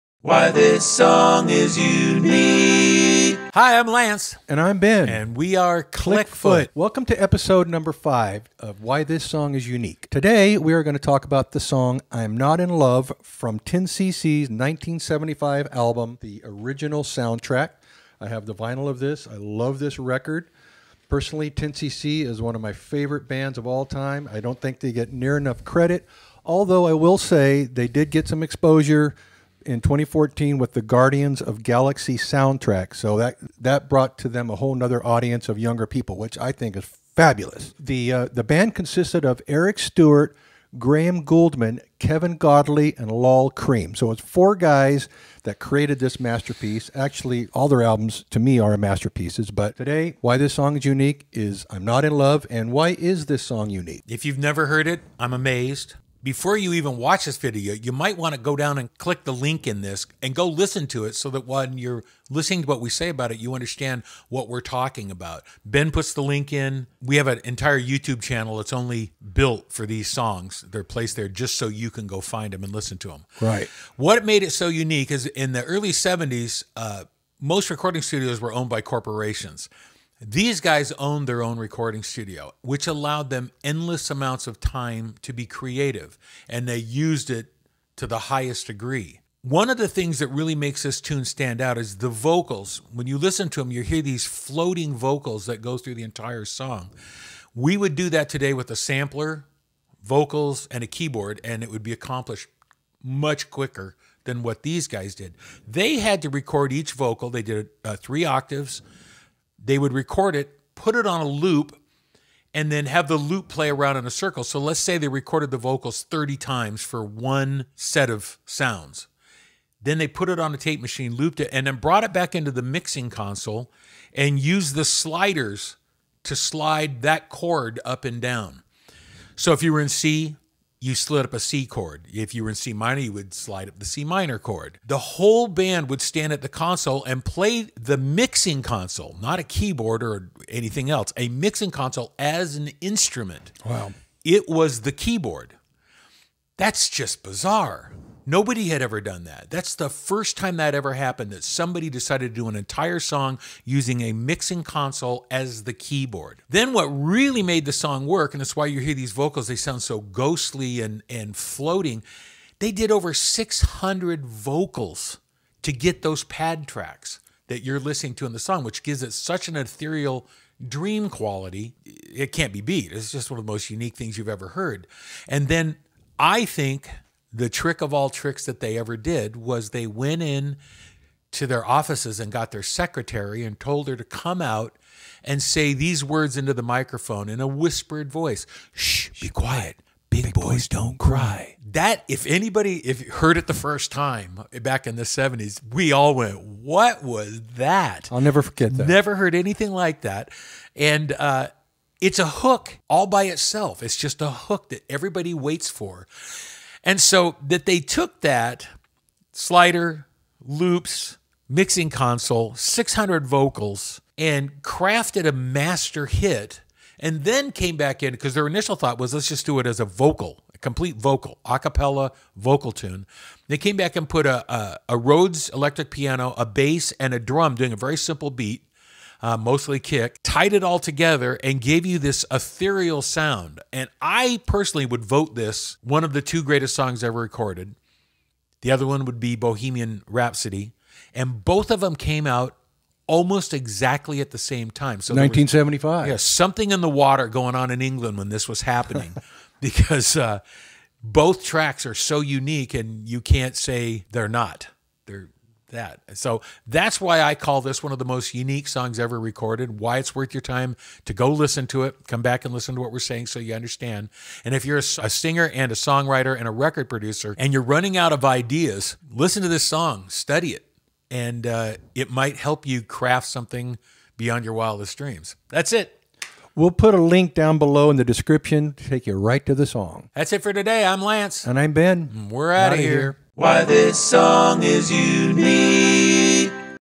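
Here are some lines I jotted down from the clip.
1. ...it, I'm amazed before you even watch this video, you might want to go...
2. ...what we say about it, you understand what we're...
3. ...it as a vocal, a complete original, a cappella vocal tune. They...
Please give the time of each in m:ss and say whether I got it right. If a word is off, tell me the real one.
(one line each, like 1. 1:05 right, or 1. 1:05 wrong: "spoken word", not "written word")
1. 0:54 right
2. 1:02 right
3. 3:39 wrong: "vocal", not "original".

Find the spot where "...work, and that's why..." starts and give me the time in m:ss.
2:38.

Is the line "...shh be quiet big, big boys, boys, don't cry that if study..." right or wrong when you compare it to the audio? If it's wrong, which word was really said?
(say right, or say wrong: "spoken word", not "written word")
wrong: "anybody", not "study".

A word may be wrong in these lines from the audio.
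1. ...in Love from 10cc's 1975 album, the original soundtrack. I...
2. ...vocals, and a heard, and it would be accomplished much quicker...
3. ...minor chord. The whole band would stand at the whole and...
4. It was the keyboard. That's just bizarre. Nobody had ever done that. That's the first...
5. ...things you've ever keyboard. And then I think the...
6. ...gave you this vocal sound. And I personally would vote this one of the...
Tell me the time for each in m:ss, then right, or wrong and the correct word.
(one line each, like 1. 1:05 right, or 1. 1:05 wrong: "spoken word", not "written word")
1. 0:12 right
2. 1:40 wrong: "keyboard", not "heard"
3. 2:14 wrong: "console", not "whole"
4. 2:24 right
5. 2:53 wrong: "heard", not "keyboard"
6. 3:51 wrong: "ethereal", not "vocal".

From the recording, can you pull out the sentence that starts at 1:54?
So let's say they recorded the vocals 30 times for one set of sounds.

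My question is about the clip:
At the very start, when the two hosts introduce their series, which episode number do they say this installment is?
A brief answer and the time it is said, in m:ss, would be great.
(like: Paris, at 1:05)
5, at 0:07.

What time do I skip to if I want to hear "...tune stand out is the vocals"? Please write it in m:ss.
1:31.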